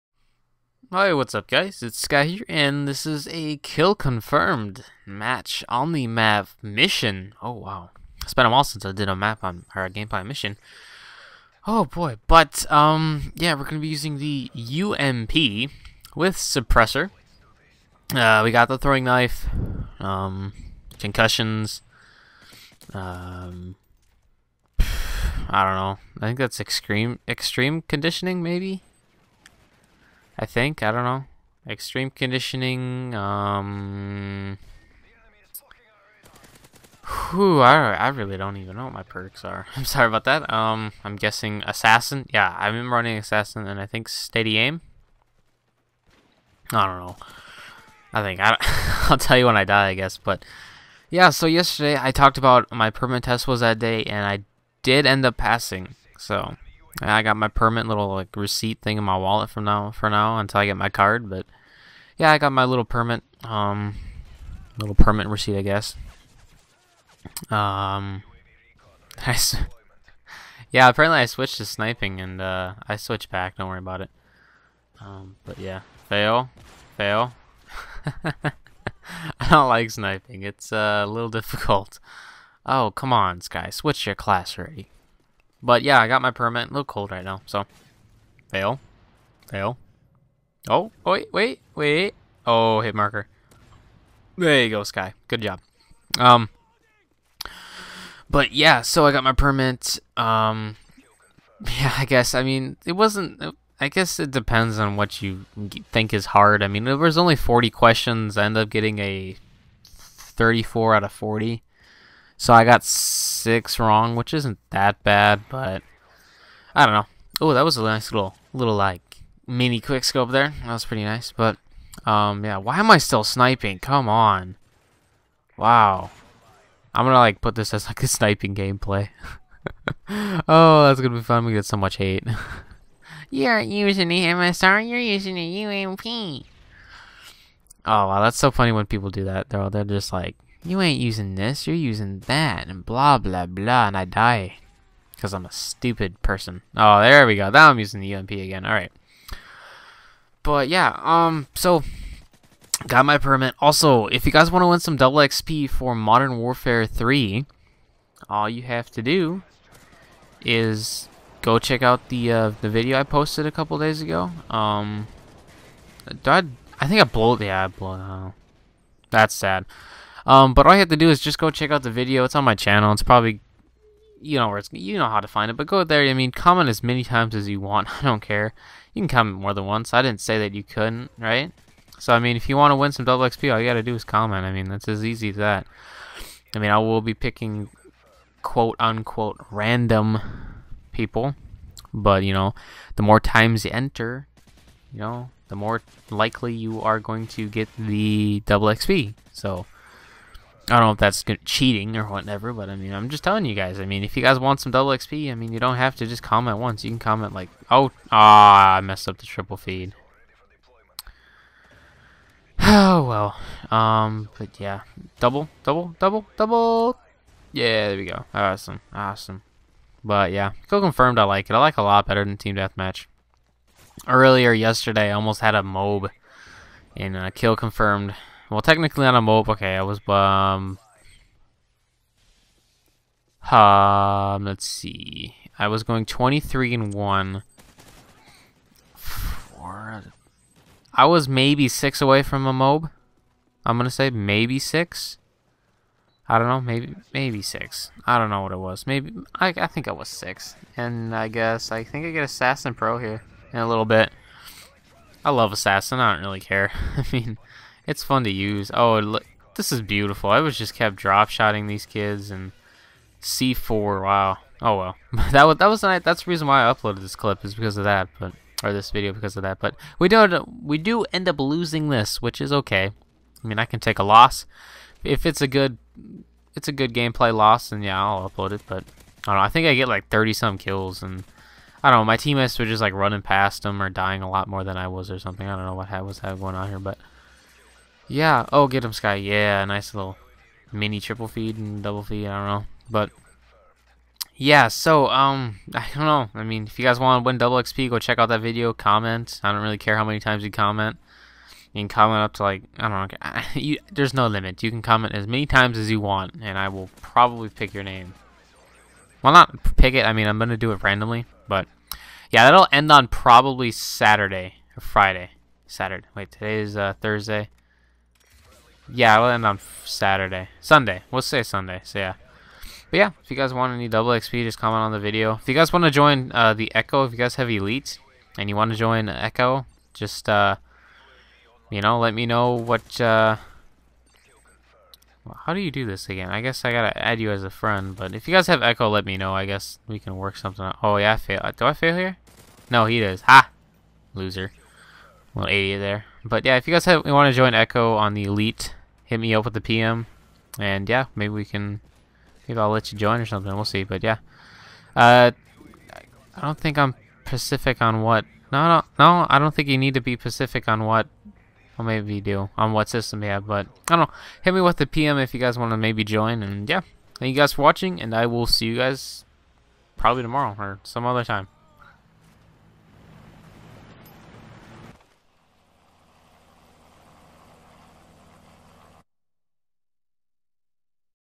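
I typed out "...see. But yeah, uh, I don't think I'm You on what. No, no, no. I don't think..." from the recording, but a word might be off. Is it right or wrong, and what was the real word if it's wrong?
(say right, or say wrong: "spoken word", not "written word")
wrong: "Pacific", not "You".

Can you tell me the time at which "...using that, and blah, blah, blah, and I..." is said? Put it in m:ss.
2:21.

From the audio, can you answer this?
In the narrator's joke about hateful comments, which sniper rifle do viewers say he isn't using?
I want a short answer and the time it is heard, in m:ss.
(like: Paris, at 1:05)
MSR, at 2:14.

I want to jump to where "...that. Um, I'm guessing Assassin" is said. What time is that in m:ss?
0:40.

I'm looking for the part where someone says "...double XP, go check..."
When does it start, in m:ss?
4:57.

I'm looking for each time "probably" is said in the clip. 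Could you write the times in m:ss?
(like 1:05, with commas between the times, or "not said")
2:53, 5:07, 5:13, 6:09.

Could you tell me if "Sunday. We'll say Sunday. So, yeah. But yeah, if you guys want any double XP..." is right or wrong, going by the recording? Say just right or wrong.
right.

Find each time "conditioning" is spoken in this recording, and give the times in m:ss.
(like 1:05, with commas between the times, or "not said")
0:27, 0:32.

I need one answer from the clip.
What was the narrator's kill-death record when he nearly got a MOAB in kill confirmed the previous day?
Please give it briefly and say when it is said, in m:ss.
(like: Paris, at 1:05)
23 and 1, at 3:56.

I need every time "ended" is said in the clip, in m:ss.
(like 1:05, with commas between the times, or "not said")
1:48.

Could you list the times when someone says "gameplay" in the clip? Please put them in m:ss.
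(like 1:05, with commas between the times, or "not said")
0:09, 2:08, 4:36.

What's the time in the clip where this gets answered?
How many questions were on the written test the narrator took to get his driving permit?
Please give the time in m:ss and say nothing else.
1:47.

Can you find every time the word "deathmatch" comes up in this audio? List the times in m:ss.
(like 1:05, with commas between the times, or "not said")
3:42.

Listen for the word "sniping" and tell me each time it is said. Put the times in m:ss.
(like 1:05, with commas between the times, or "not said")
1:11, 1:19, 2:03, 2:08.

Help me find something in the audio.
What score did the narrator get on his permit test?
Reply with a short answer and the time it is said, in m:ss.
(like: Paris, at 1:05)
34 out of 40, at 1:49.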